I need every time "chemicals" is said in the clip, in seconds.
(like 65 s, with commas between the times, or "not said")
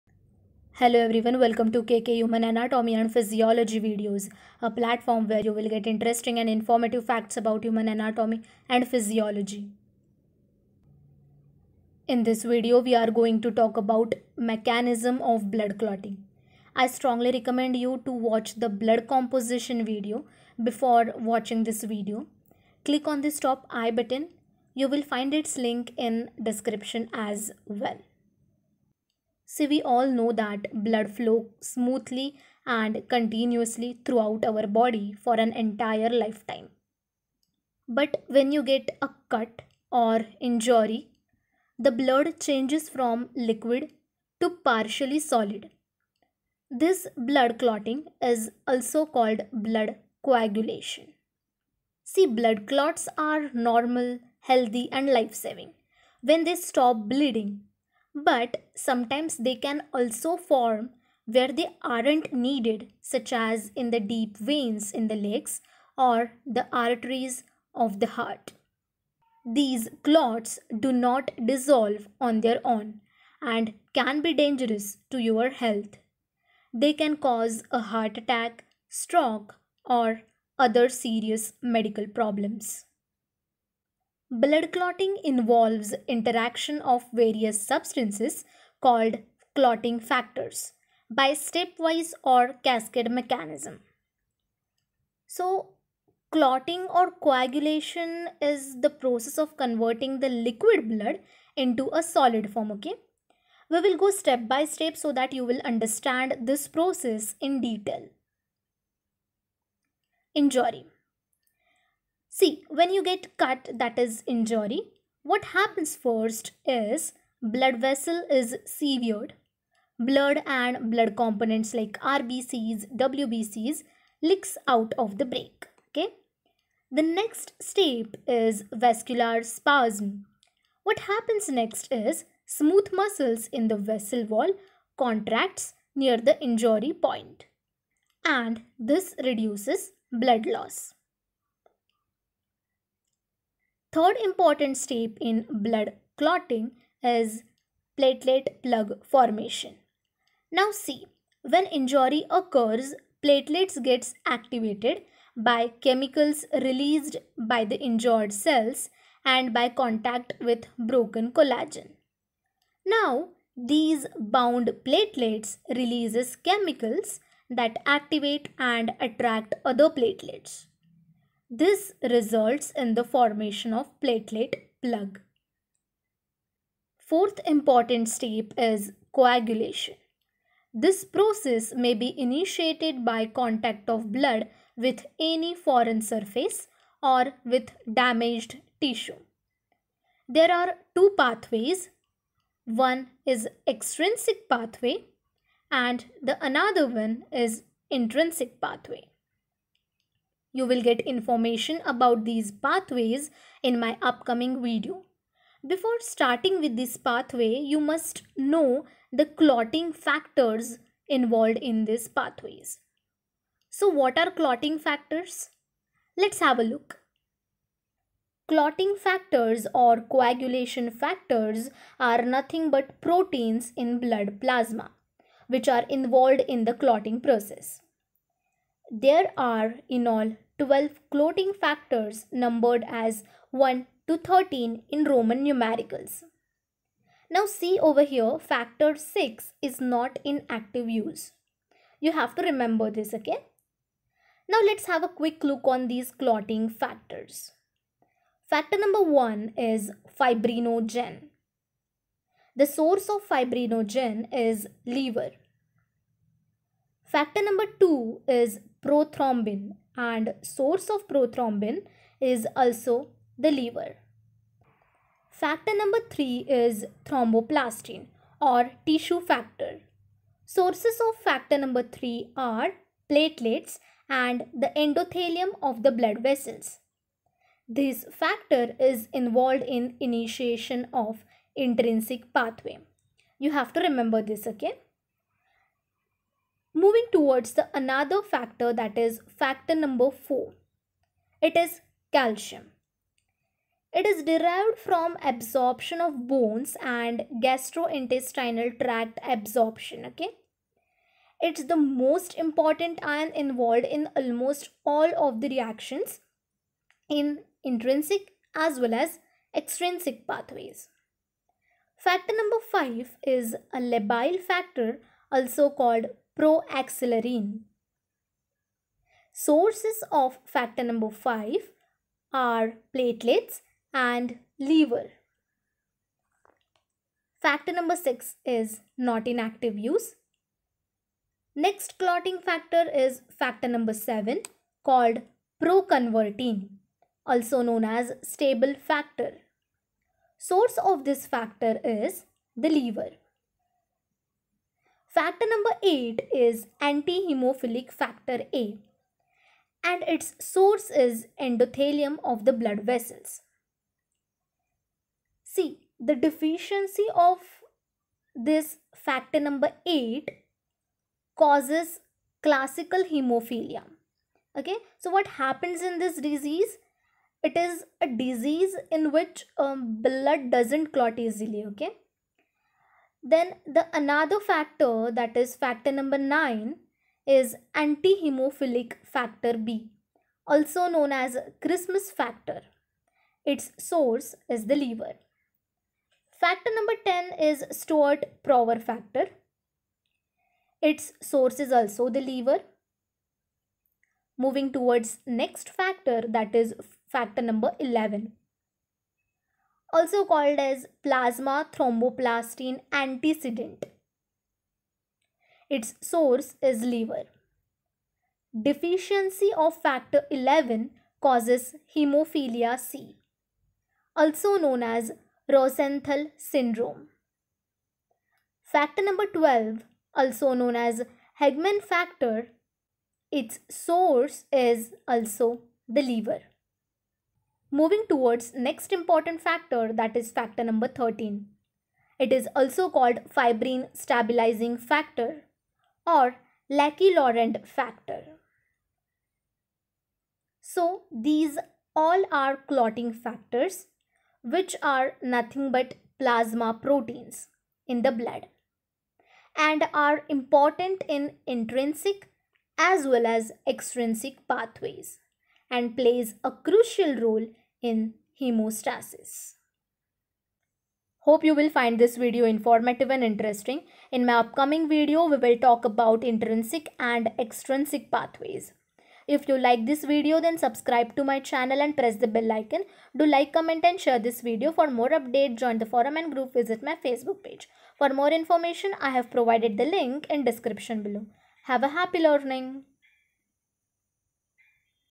155 s, 166 s.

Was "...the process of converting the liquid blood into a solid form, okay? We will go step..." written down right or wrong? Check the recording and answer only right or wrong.
right.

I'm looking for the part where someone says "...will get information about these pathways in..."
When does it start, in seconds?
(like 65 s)
200 s.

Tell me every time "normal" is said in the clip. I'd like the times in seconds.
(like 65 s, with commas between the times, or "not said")
53 s.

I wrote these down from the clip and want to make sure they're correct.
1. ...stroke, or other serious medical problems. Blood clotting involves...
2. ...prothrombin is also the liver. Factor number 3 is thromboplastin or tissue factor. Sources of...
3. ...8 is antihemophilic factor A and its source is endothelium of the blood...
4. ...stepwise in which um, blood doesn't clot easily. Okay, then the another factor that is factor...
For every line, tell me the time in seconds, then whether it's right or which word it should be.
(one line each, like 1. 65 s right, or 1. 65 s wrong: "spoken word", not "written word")
1. 78 s right
2. 261 s right
3. 345 s right
4. 368 s wrong: "disease", not "stepwise".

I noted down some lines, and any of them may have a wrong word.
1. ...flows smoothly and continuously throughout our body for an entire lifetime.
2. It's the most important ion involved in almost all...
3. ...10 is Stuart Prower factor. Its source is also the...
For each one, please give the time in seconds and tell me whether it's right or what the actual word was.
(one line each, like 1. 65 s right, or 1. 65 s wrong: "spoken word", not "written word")
1. 31 s right
2. 301 s right
3. 387 s right.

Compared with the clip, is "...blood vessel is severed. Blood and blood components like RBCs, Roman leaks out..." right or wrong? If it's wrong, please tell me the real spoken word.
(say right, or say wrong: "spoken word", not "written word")
wrong: "WBCs", not "Roman".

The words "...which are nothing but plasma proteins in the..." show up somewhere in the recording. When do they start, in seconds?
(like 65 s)
444 s.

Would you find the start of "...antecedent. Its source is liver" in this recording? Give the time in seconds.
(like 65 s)
402 s.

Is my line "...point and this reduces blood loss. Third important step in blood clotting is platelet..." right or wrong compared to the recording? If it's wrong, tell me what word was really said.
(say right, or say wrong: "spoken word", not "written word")
right.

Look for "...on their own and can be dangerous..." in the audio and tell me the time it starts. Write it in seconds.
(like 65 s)
72 s.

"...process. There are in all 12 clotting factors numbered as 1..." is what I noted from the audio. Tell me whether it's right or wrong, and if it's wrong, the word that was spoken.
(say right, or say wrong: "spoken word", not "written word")
right.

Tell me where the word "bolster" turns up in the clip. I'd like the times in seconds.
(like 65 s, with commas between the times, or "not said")
not said.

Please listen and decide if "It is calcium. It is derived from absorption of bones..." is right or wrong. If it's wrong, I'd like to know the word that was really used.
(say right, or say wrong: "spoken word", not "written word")
right.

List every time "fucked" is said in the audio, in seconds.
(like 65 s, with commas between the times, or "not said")
not said.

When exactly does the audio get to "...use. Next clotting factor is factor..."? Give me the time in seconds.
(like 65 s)
329 s.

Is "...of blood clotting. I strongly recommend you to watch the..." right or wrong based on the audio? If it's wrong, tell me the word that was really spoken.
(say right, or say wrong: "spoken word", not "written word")
right.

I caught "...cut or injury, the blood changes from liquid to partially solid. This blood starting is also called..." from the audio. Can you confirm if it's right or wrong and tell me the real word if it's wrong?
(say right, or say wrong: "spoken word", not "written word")
wrong: "clotting", not "starting".